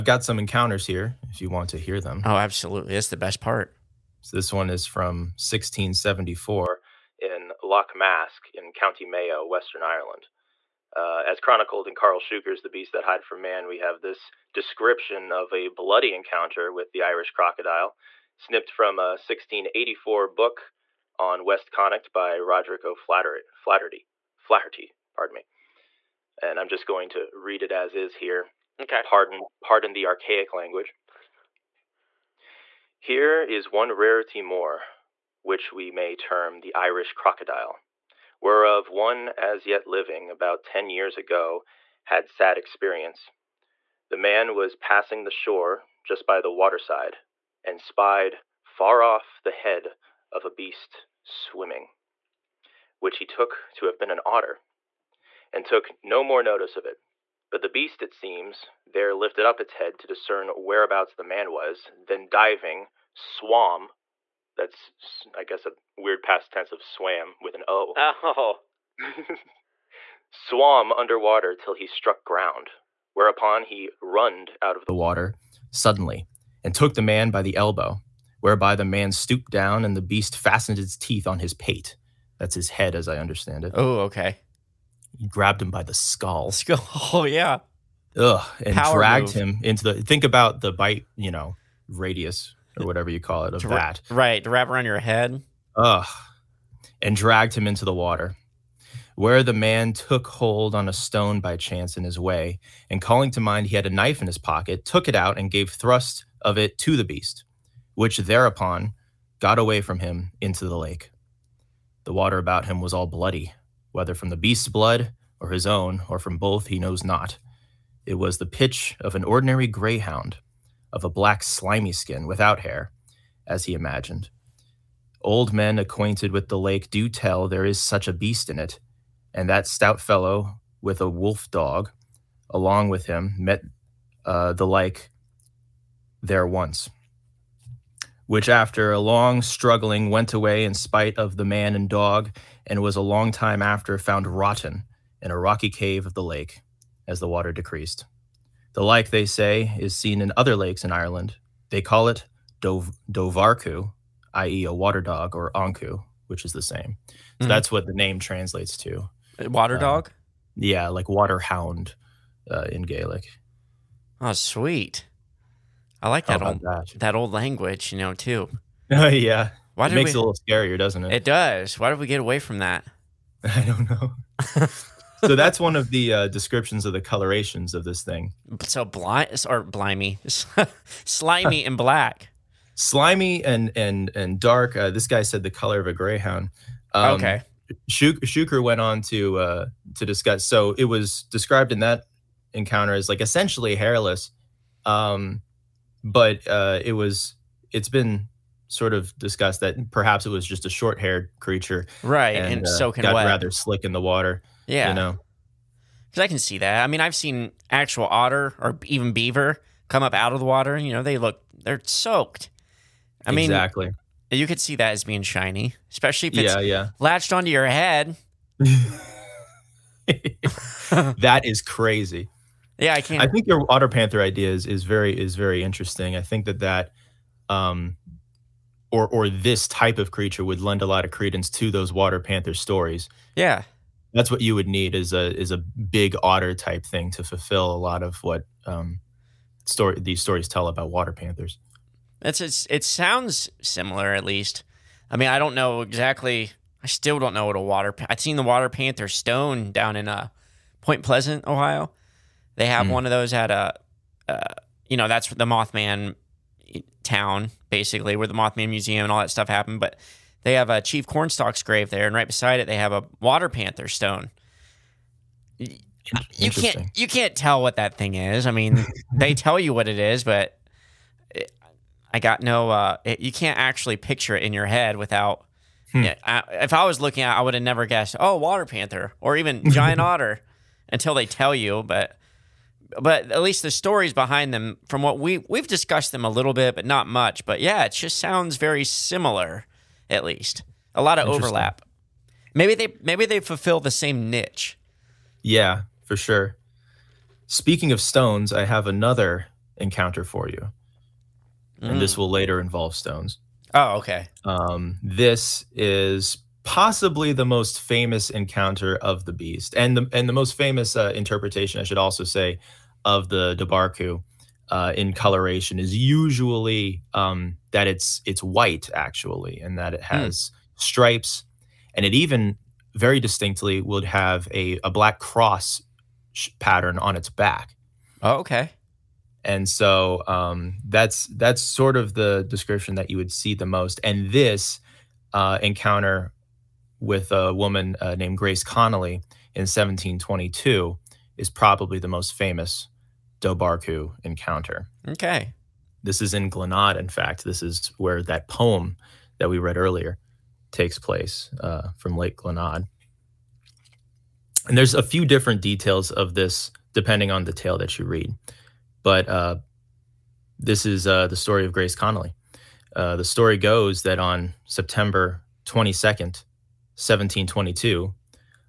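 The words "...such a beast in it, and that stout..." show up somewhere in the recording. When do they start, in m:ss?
2:07.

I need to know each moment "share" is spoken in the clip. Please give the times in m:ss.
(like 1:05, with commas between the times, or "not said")
not said.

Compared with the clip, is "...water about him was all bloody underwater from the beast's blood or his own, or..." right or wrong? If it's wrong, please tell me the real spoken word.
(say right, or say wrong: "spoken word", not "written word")
wrong: "whether", not "underwater".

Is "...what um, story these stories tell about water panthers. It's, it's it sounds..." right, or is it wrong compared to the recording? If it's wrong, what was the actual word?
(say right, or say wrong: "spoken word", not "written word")
right.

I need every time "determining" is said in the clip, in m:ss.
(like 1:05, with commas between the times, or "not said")
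not said.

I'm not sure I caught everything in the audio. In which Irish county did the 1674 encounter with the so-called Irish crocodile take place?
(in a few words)
County Mayo.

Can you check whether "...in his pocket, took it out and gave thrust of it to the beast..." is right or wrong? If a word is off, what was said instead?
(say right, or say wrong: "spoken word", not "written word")
right.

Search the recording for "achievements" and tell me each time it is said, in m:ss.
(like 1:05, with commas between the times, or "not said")
not said.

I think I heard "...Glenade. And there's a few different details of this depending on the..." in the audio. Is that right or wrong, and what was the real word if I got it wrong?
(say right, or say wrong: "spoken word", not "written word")
right.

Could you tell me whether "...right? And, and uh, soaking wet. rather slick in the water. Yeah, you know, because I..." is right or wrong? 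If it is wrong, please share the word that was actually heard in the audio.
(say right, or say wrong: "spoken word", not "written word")
right.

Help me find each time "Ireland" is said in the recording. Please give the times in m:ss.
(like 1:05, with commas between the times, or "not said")
0:09, 2:30.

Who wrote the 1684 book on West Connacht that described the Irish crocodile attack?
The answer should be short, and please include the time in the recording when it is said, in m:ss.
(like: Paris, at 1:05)
Roderick O'Flaherty, at 0:22.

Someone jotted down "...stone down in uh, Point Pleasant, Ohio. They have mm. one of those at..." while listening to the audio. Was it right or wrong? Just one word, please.
right.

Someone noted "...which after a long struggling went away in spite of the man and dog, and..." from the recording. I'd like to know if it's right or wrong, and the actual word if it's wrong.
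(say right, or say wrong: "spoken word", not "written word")
right.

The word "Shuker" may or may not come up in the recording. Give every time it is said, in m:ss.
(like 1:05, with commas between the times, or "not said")
0:12, 3:07.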